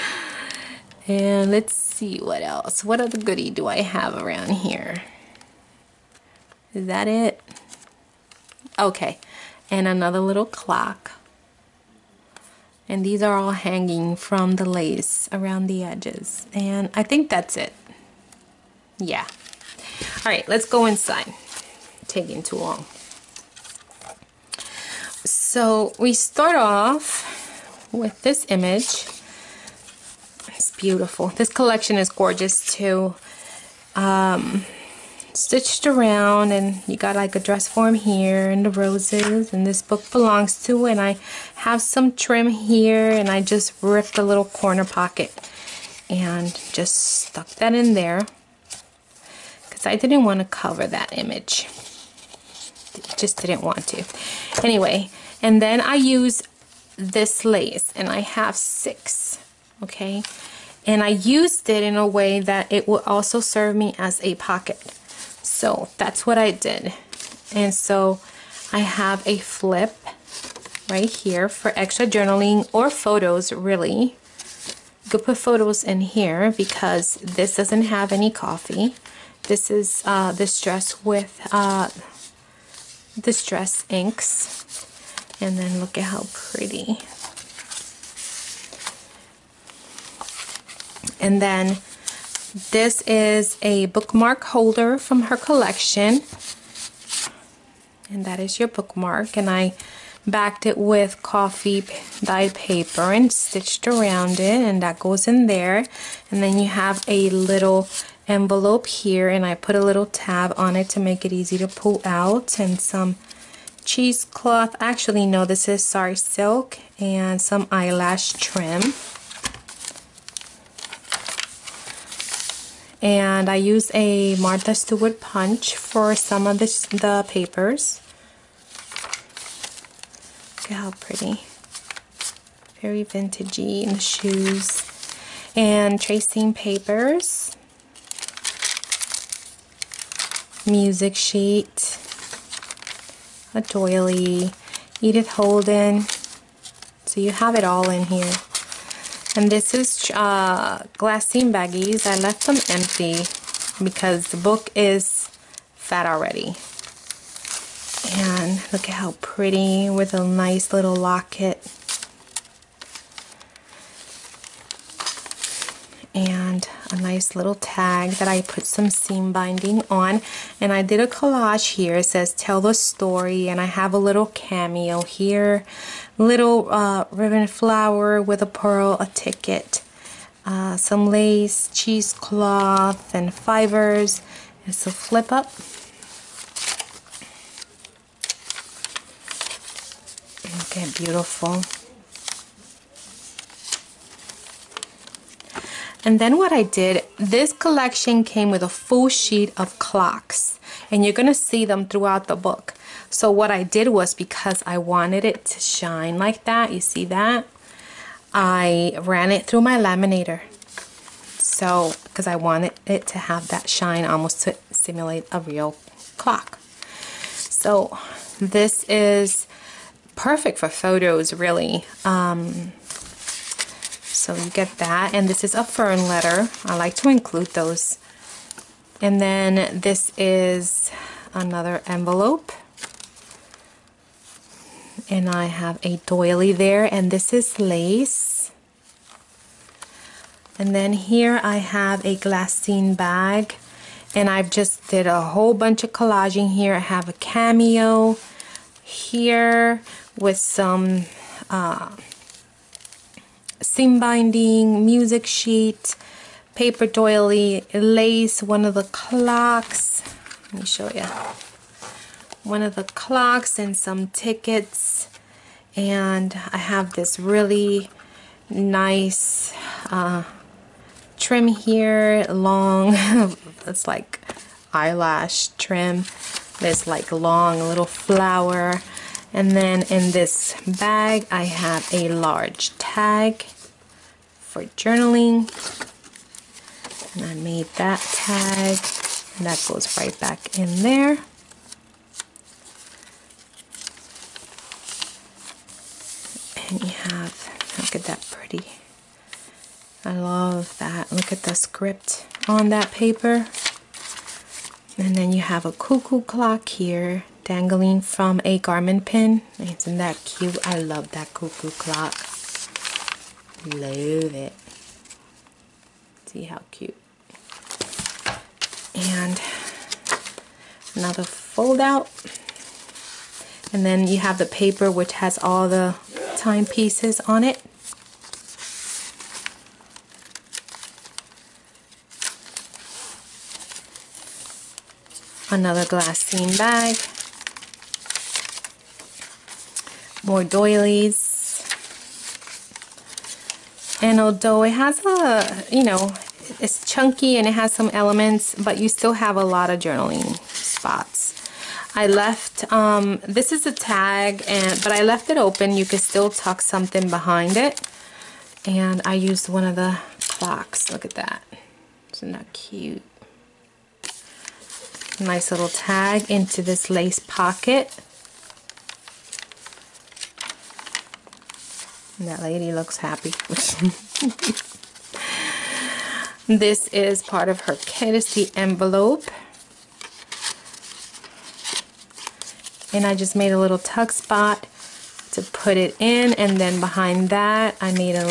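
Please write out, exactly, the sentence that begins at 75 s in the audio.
You could put photos in here because this doesn't have any coffee.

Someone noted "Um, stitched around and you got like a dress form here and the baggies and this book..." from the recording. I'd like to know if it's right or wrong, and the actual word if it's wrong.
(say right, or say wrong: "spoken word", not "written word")
wrong: "roses", not "baggies".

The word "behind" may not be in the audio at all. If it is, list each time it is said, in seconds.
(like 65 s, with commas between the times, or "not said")
357 s, 386 s.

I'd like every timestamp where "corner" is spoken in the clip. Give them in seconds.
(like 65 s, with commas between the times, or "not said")
44 s.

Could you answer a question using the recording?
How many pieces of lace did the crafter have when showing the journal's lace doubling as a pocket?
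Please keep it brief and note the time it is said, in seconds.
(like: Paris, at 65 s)
6, at 58 s.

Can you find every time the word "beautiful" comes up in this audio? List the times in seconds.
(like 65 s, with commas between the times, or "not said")
30 s, 191 s.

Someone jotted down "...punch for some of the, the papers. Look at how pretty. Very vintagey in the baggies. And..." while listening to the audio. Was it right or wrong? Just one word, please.
wrong.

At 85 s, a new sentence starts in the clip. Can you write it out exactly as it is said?
And then look at how pretty And then this is a bookmark holder from her collection.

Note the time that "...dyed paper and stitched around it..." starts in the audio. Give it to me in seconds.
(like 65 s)
102 s.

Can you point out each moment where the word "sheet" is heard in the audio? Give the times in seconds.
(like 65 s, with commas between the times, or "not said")
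141 s, 199 s, 255 s.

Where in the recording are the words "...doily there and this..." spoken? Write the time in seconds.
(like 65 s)
236 s.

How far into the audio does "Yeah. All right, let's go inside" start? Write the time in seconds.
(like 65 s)
18 s.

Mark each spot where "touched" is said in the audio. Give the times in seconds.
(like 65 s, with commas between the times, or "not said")
not said.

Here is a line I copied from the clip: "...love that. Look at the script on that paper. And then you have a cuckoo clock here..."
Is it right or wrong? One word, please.
right.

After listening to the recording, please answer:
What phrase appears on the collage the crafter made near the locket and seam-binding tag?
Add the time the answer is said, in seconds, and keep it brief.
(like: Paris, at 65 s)
tell the story, at 172 s.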